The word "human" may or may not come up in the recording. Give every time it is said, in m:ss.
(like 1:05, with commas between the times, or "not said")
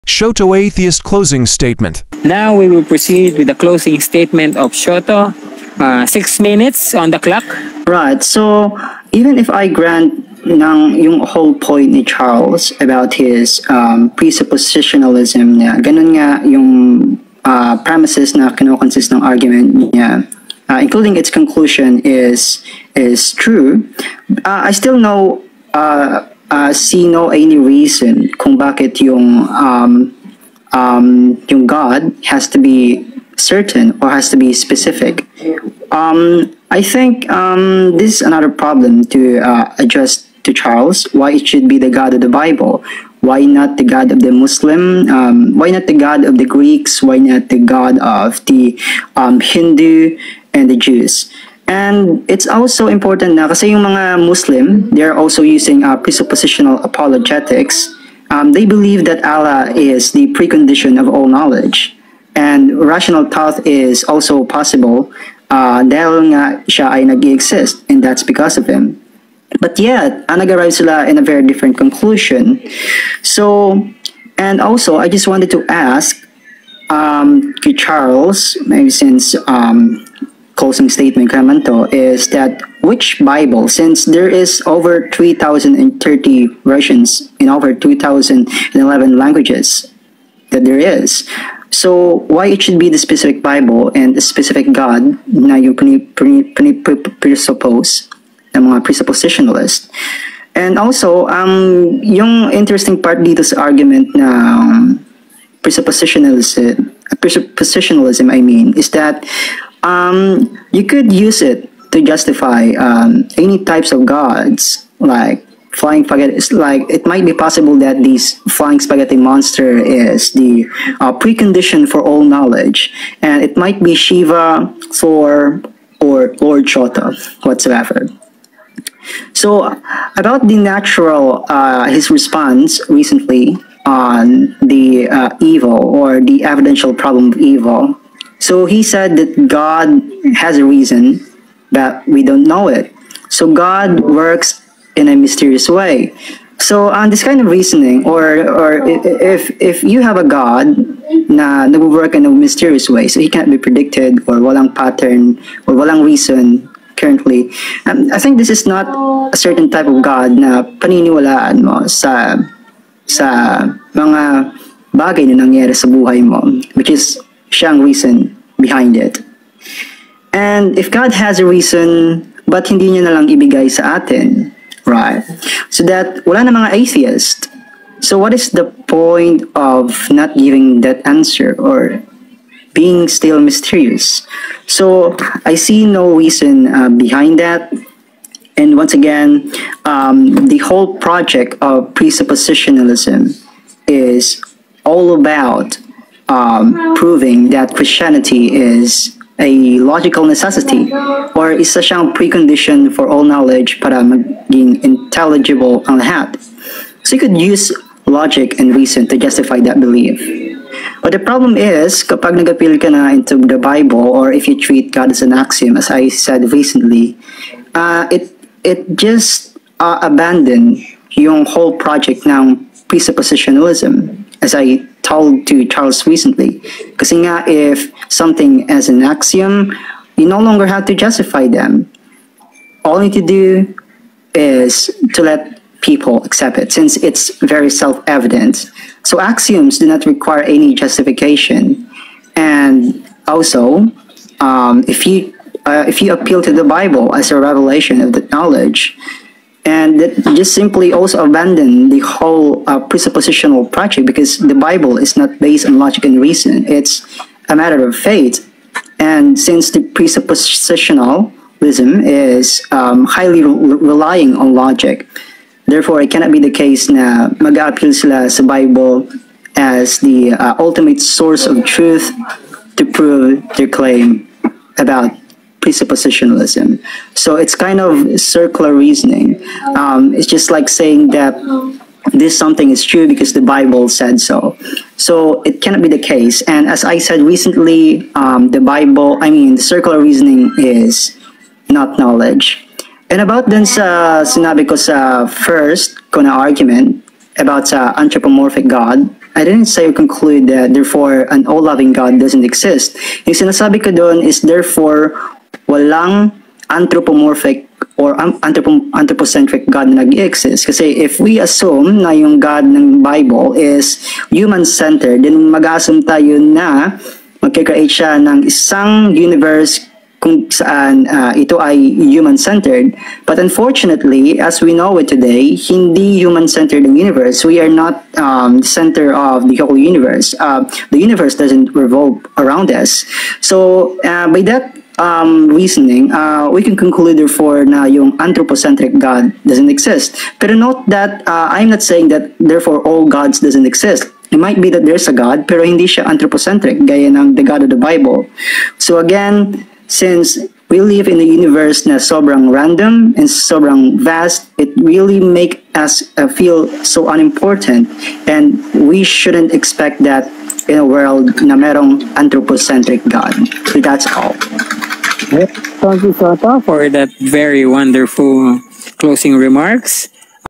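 5:14, 5:21, 5:26.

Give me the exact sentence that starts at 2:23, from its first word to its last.
So God works in a mysterious way.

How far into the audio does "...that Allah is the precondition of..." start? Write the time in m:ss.
0:59.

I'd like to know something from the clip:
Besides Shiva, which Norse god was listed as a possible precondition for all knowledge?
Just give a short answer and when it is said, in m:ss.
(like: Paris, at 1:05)
Thor, at 2:04.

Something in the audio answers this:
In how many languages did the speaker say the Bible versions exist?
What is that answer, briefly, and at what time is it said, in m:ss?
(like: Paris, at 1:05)
2,011, at 1:27.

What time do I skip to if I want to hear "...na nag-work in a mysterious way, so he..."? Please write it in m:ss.
2:31.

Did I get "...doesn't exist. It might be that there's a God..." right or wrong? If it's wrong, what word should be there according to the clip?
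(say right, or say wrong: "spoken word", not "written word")
right.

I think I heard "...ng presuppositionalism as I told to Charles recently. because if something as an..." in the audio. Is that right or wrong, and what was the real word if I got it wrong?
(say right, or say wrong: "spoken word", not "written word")
right.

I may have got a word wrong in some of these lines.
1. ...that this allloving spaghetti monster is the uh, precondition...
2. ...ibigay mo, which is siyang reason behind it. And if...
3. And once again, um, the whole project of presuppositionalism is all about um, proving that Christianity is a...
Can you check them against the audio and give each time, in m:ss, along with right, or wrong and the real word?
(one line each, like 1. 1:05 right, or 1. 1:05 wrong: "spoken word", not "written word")
1. 1:57 wrong: "flying", not "allloving"
2. 2:45 wrong: "buhay", not "ibigay"
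3. 3:08 right.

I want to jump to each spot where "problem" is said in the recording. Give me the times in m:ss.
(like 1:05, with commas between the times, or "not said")
0:38, 2:16, 3:31.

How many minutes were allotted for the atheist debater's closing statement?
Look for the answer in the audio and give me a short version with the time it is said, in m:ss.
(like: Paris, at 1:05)
6, at 0:06.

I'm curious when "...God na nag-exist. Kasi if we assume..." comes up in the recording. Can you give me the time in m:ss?
5:09.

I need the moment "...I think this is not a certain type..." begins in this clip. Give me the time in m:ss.
2:38.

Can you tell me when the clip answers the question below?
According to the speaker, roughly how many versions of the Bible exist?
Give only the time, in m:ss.
1:25.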